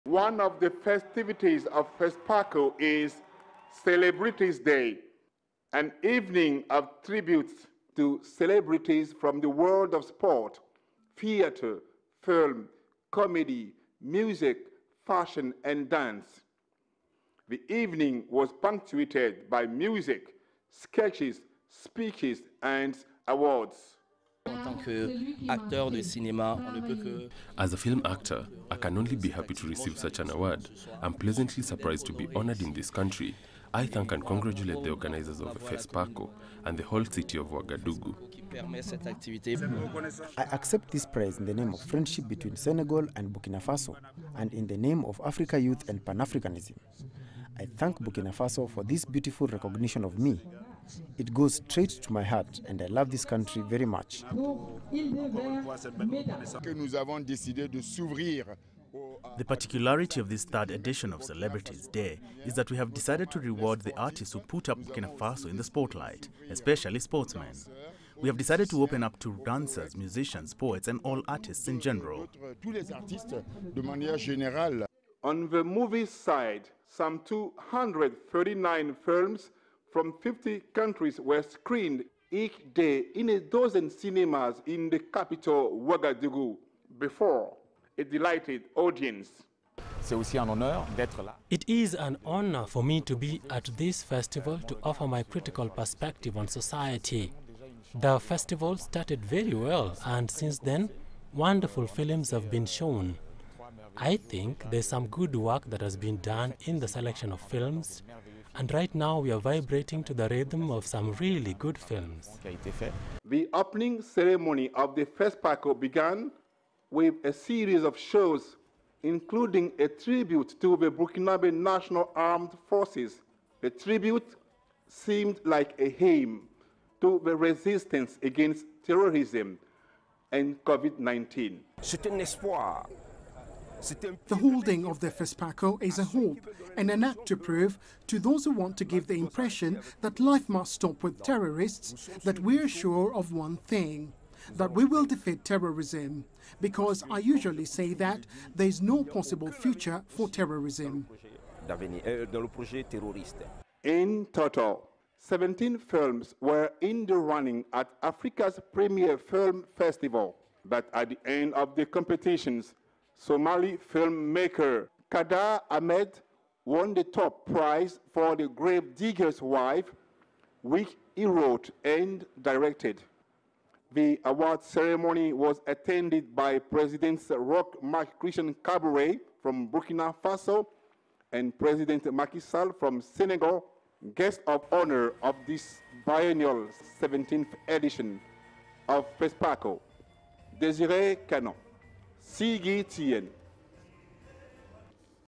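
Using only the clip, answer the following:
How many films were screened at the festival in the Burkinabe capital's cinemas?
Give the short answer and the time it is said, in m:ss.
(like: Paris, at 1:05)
239, at 1:17.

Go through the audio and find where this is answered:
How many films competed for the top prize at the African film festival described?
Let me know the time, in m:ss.
2:35.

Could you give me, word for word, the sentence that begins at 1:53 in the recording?
The opening ceremony of the FESPACO began with a series of shows, including a tribute to the Burkinabe National Armed Forces.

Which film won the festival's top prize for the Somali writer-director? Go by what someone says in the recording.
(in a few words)
The Grave Digger's Wife.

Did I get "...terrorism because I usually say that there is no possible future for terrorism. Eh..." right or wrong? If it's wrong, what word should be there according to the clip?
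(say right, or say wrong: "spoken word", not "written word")
right.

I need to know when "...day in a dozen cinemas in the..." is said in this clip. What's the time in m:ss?
1:22.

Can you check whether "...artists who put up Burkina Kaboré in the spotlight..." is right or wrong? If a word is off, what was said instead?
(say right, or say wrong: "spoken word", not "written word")
wrong: "Faso", not "Kaboré".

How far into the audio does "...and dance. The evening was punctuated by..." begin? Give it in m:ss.
0:15.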